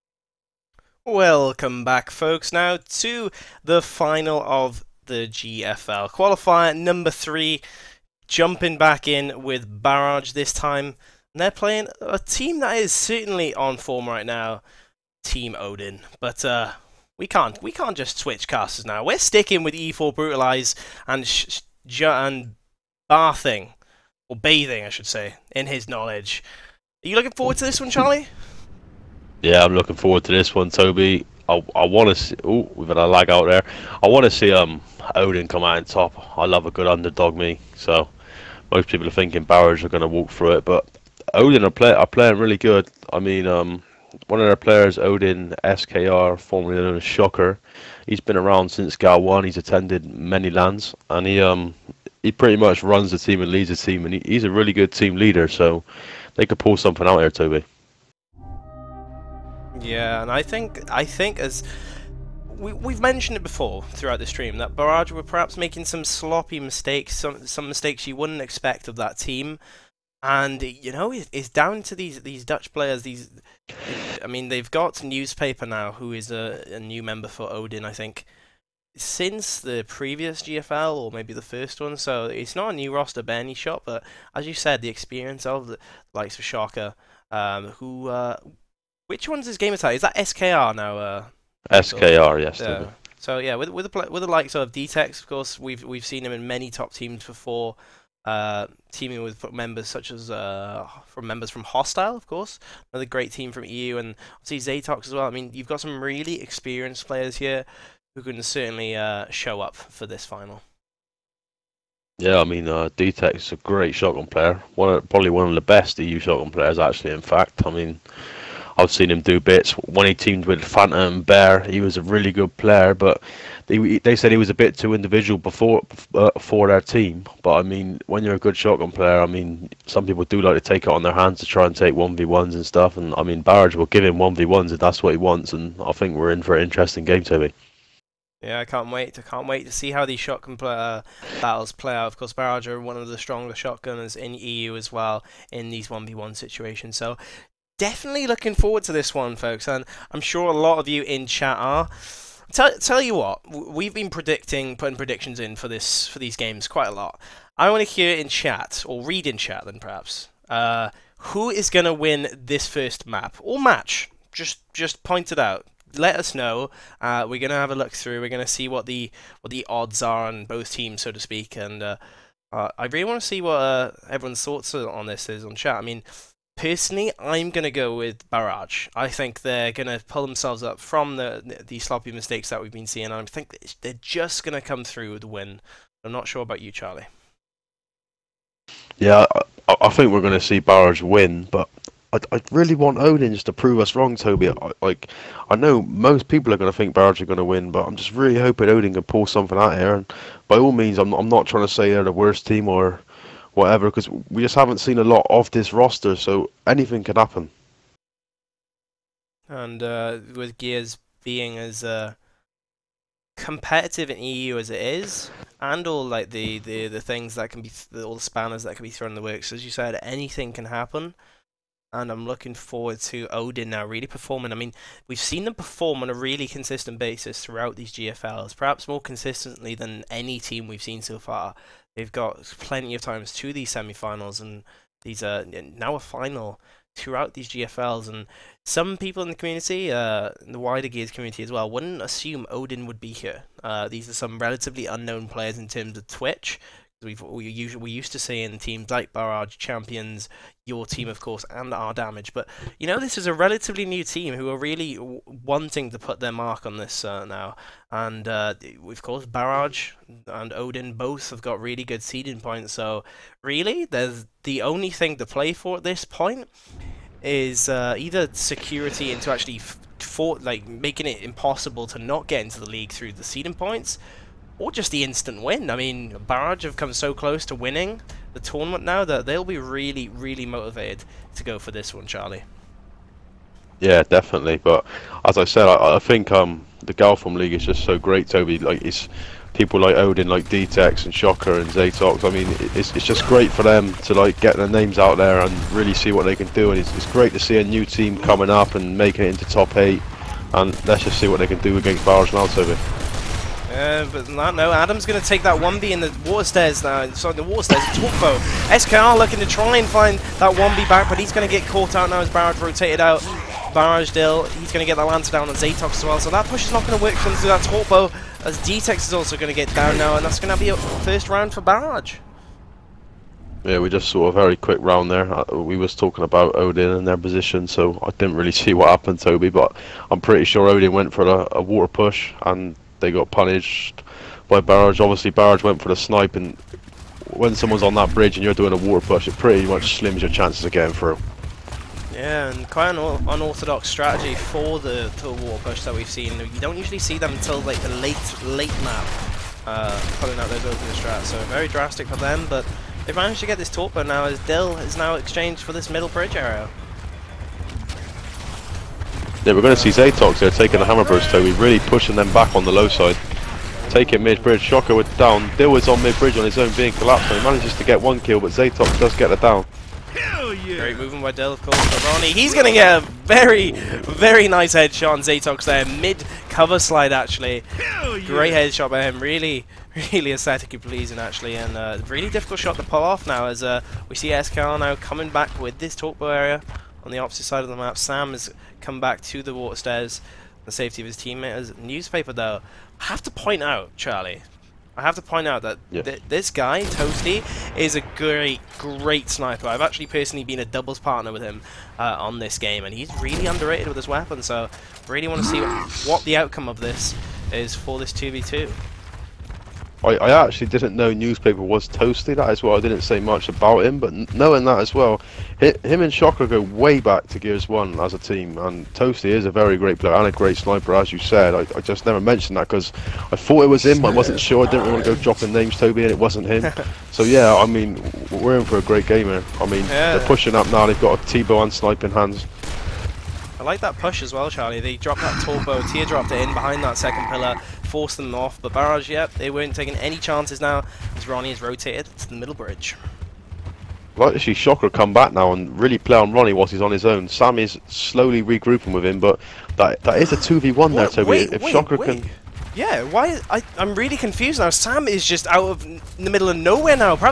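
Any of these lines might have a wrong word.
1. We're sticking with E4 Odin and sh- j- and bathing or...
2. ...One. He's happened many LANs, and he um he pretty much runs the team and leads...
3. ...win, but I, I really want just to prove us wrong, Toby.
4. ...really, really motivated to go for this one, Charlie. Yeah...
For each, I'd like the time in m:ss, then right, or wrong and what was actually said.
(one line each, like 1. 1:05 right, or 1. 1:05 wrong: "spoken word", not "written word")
1. 0:19 wrong: "Brutalize", not "Odin"
2. 0:49 wrong: "attended", not "happened"
3. 3:11 right
4. 4:39 right.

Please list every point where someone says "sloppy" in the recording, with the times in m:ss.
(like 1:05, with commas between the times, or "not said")
1:06, 3:01.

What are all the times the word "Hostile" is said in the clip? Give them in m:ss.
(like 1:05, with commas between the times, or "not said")
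1:41.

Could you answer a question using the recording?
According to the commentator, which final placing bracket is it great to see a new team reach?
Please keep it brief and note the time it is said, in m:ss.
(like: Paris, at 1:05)
top eight, at 4:59.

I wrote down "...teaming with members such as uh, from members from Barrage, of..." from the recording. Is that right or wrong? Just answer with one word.
wrong.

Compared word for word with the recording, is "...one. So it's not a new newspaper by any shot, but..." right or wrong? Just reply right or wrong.
wrong.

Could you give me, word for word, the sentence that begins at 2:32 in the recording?
Tell, tell you what, we've been predicting, putting predictions in for this for these games quite a lot.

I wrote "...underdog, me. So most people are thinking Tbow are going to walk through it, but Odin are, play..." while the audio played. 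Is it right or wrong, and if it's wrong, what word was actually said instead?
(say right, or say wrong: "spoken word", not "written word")
wrong: "Barrage", not "Tbow".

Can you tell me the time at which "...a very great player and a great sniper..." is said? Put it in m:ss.
6:59.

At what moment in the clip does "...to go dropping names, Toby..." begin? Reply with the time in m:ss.
7:05.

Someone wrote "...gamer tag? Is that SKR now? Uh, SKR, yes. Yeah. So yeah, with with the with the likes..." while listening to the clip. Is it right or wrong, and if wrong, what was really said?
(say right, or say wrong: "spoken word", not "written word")
right.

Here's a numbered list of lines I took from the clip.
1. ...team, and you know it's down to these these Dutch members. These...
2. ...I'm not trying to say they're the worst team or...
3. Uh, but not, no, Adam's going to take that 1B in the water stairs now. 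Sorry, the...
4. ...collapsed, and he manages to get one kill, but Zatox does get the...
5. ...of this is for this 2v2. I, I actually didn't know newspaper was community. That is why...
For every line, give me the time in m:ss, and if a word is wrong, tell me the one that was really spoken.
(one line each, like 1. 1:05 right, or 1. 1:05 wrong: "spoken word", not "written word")
1. 1:09 wrong: "players", not "members"
2. 3:21 right
3. 5:03 right
4. 6:06 right
5. 6:46 wrong: "toasty", not "community".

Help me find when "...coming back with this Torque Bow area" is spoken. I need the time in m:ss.
6:24.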